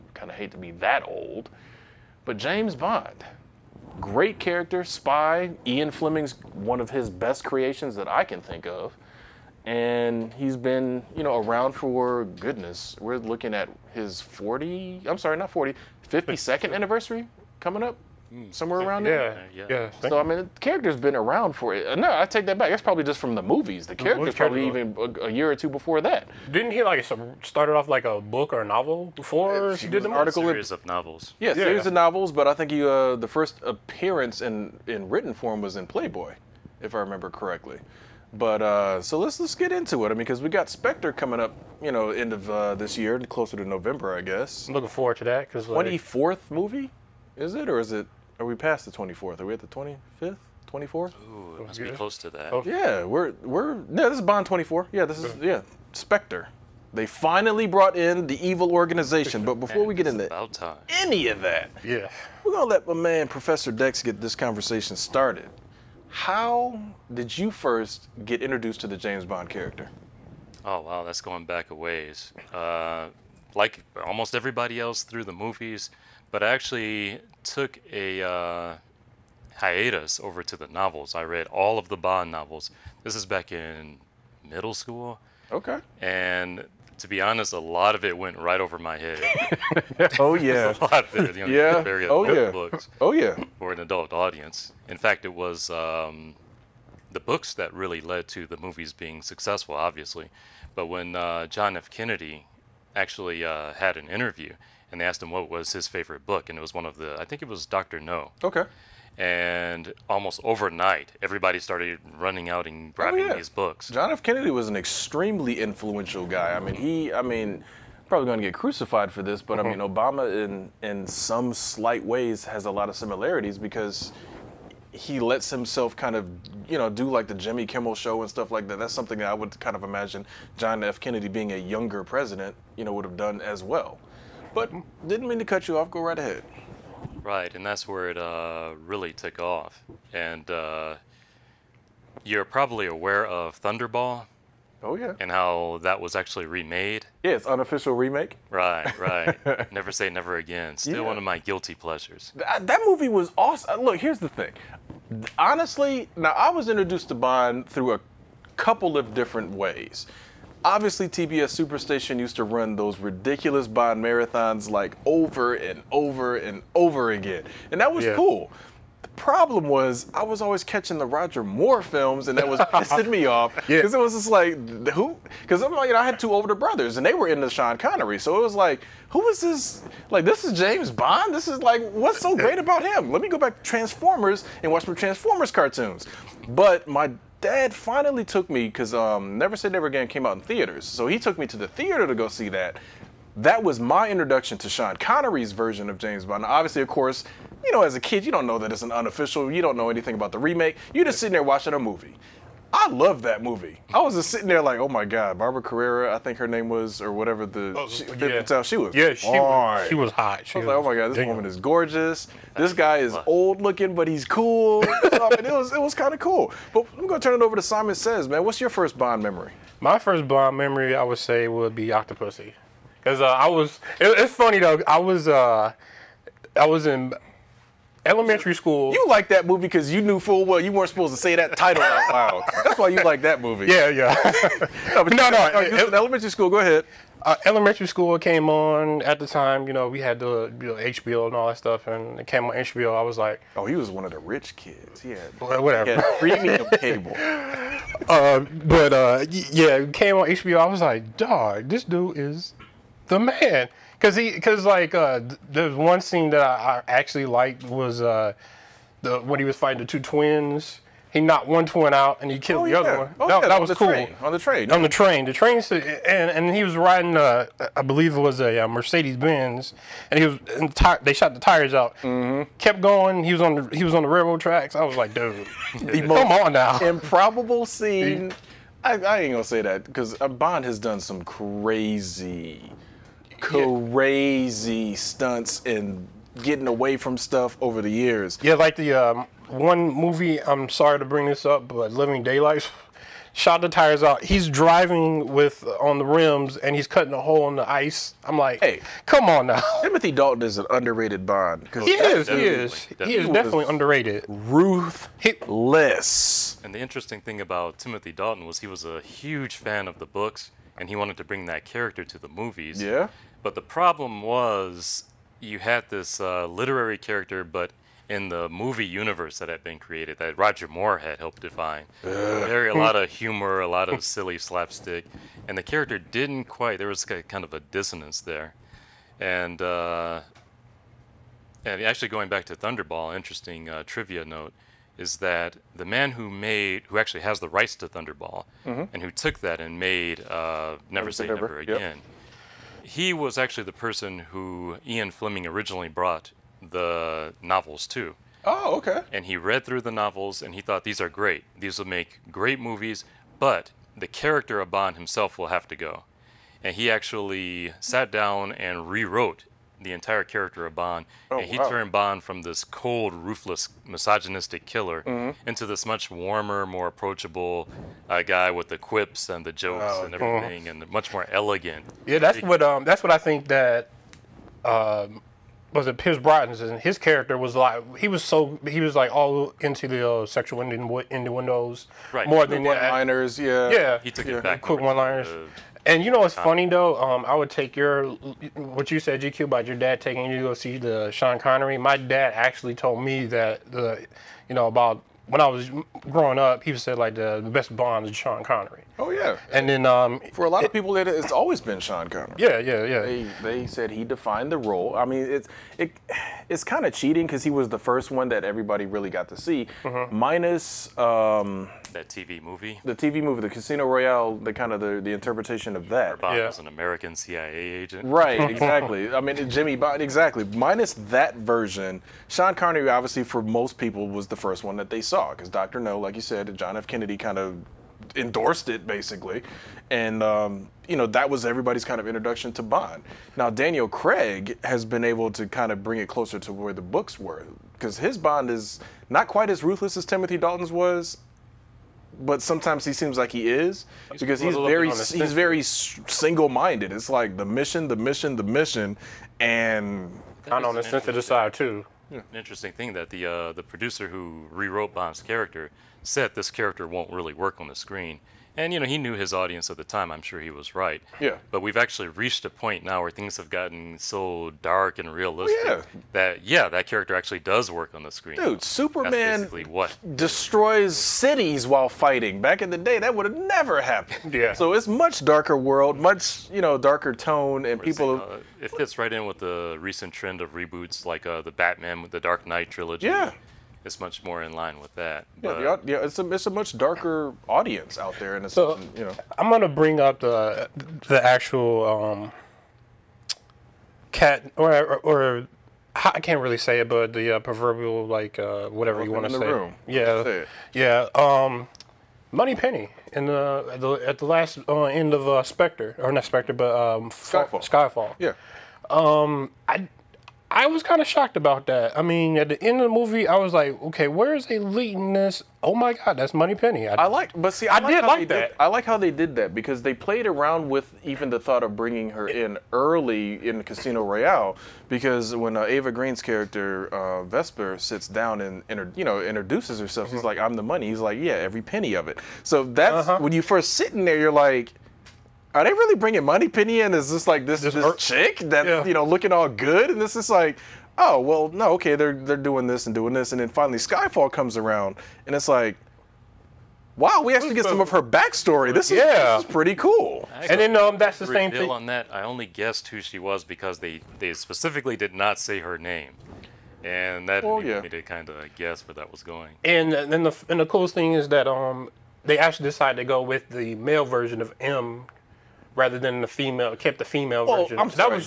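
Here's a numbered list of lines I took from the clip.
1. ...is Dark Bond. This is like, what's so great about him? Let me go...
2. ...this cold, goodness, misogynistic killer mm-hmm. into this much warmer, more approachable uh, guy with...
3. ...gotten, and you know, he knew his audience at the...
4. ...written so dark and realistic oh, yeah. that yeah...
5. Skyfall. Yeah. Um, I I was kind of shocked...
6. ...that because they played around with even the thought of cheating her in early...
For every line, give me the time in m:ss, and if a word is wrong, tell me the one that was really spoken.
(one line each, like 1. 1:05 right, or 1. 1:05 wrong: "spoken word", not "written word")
1. 3:00 wrong: "James", not "Dark"
2. 6:02 wrong: "ruthless", not "goodness"
3. 7:37 wrong: "screen", not "gotten"
4. 7:43 wrong: "gotten", not "written"
5. 8:27 right
6. 8:39 wrong: "bringing", not "cheating".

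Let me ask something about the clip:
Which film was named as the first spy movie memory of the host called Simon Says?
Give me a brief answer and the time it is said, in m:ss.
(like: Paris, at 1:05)
Octopussy, at 3:41.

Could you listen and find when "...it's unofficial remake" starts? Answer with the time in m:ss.
2:27.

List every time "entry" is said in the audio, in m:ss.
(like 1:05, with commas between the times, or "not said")
not said.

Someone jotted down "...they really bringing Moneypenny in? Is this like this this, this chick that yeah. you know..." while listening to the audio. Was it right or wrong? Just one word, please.
right.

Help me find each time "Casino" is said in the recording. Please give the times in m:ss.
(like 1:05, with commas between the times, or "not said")
6:53, 8:43.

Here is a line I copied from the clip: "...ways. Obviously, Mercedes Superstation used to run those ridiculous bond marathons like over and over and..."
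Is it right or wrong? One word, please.
wrong.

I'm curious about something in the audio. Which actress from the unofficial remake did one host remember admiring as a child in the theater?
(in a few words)
Barbara Carrera.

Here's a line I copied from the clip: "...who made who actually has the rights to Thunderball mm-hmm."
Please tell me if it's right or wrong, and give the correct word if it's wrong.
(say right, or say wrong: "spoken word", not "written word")
right.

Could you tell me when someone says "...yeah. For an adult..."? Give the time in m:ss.
1:33.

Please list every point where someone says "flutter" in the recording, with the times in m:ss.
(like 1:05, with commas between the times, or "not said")
not said.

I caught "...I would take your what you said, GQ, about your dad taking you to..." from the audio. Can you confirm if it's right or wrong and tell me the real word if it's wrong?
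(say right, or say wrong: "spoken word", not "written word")
right.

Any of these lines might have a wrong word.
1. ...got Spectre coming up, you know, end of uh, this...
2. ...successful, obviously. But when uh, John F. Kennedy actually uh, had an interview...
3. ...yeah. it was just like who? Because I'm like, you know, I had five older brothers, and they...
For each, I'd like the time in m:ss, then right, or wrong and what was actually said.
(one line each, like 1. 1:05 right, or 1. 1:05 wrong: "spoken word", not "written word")
1. 0:40 right
2. 1:39 right
3. 2:53 wrong: "two", not "five".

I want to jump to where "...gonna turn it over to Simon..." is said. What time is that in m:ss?
3:37.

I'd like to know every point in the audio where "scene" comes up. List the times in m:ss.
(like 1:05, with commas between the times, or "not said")
4:15, 4:37.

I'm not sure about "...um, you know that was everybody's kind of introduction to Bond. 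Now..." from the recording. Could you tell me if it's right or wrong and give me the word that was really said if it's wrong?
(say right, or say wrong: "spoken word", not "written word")
right.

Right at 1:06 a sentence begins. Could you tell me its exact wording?
How did you first get introduced to the James Bond character?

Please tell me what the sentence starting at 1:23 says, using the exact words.
This is back in middle school.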